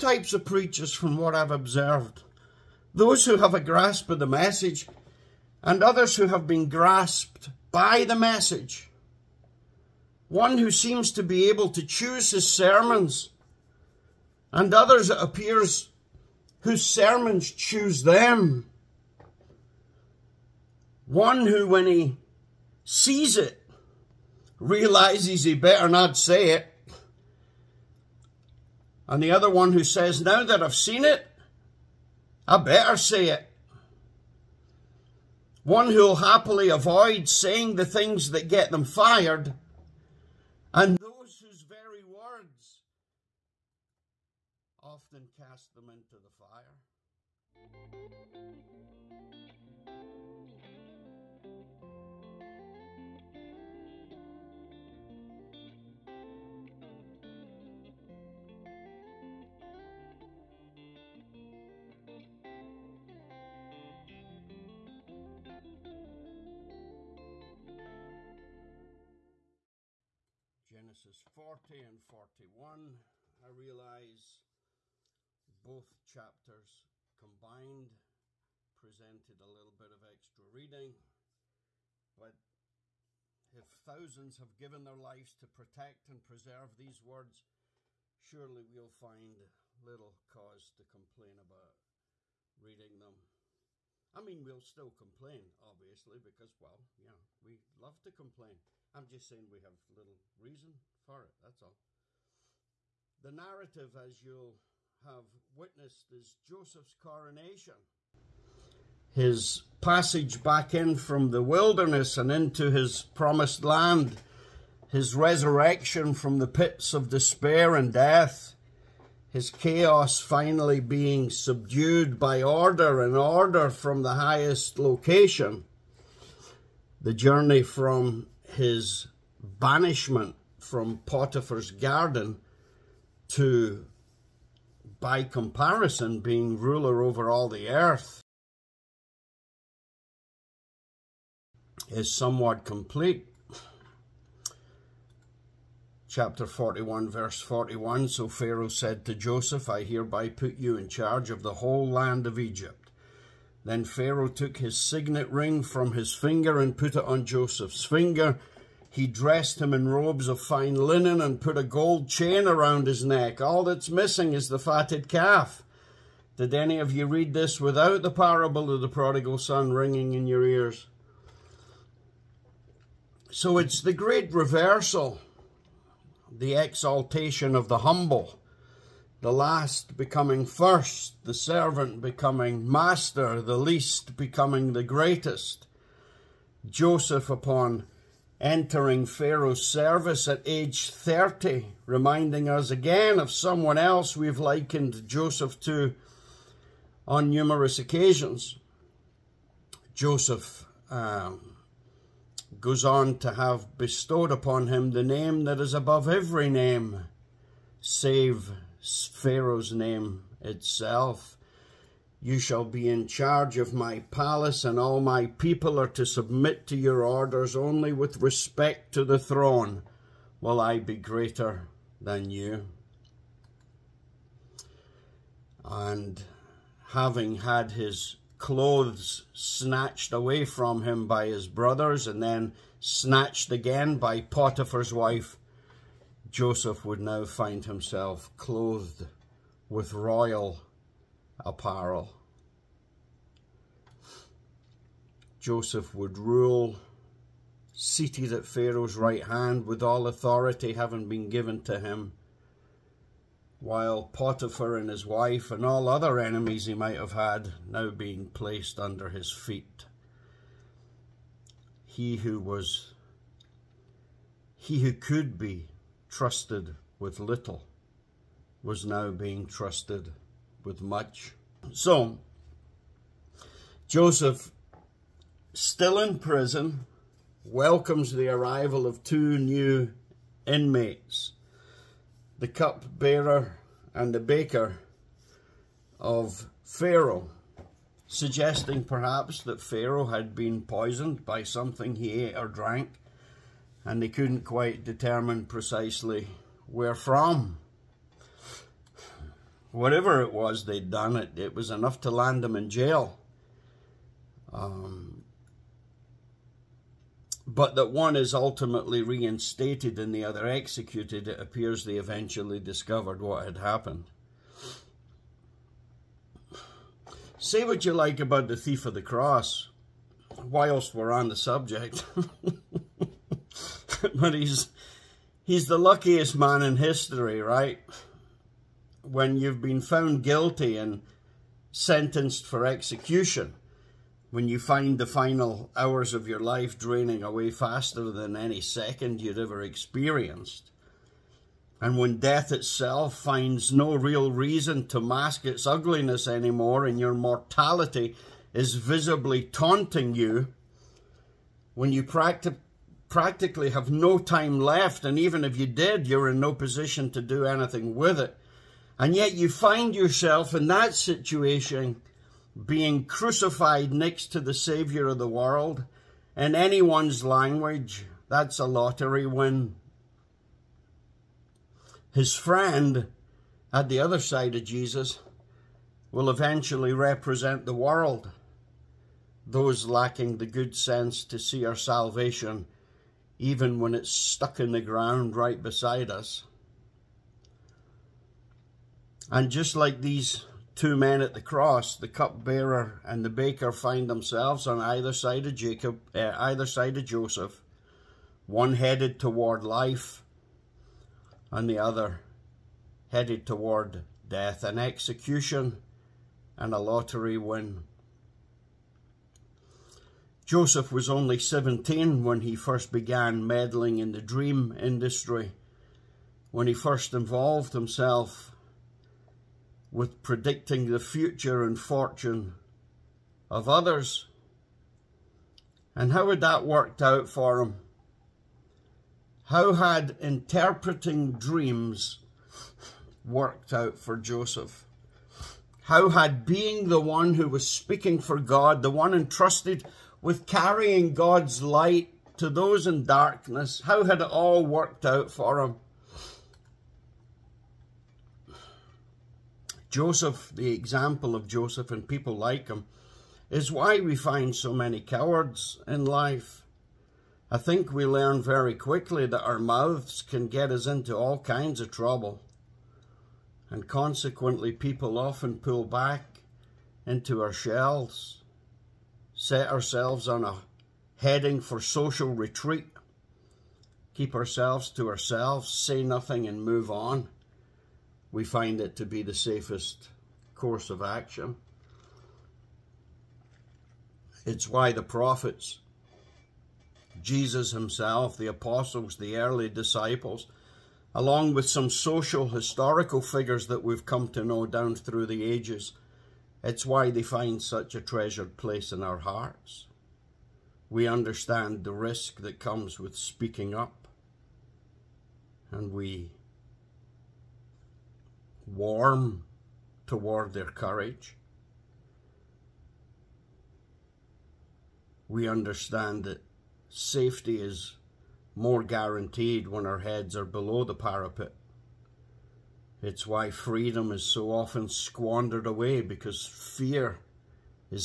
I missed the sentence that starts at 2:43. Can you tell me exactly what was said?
All that's missing is the fatted calf.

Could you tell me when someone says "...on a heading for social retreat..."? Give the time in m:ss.
7:50.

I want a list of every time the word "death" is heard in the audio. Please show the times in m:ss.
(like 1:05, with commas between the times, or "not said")
1:57, 5:42, 6:44.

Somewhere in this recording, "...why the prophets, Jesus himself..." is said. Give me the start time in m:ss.
8:04.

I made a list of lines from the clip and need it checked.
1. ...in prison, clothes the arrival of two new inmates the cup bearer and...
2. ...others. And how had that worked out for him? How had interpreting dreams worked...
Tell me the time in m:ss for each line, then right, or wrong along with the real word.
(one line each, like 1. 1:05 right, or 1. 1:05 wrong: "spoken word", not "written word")
1. 4:35 wrong: "welcomes", not "clothes"
2. 7:03 right.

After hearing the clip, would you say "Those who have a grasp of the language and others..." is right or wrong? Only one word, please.
wrong.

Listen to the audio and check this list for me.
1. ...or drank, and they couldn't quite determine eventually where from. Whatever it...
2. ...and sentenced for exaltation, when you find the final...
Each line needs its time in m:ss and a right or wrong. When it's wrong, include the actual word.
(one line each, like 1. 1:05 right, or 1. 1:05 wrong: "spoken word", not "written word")
1. 4:52 wrong: "precisely", not "eventually"
2. 5:30 wrong: "execution", not "exaltation".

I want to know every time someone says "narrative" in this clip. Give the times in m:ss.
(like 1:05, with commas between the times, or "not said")
1:43.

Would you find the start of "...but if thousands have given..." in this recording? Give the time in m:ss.
1:22.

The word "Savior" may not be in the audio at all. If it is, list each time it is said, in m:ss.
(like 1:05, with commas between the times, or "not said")
6:04.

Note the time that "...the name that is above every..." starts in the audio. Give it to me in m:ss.
3:24.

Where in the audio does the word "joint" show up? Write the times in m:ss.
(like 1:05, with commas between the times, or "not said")
not said.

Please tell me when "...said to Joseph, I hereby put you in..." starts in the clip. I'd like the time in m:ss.
2:28.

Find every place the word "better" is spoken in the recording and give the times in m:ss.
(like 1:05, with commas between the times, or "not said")
0:25, 0:32.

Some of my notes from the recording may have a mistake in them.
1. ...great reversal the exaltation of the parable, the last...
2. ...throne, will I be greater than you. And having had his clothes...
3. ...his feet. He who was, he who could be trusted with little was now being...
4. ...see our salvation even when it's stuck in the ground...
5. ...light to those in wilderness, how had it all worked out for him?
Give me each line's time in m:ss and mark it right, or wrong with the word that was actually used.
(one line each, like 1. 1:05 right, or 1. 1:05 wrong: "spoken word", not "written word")
1. 2:53 wrong: "humble", not "parable"
2. 3:39 right
3. 4:19 right
4. 6:21 right
5. 7:21 wrong: "darkness", not "wilderness".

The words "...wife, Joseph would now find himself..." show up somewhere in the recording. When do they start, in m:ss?
3:54.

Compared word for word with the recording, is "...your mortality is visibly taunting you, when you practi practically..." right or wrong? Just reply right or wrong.
right.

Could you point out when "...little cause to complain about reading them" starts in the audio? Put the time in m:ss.
1:29.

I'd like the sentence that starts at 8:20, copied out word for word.
We understand the risk that comes with speaking up, and we warm toward their courage.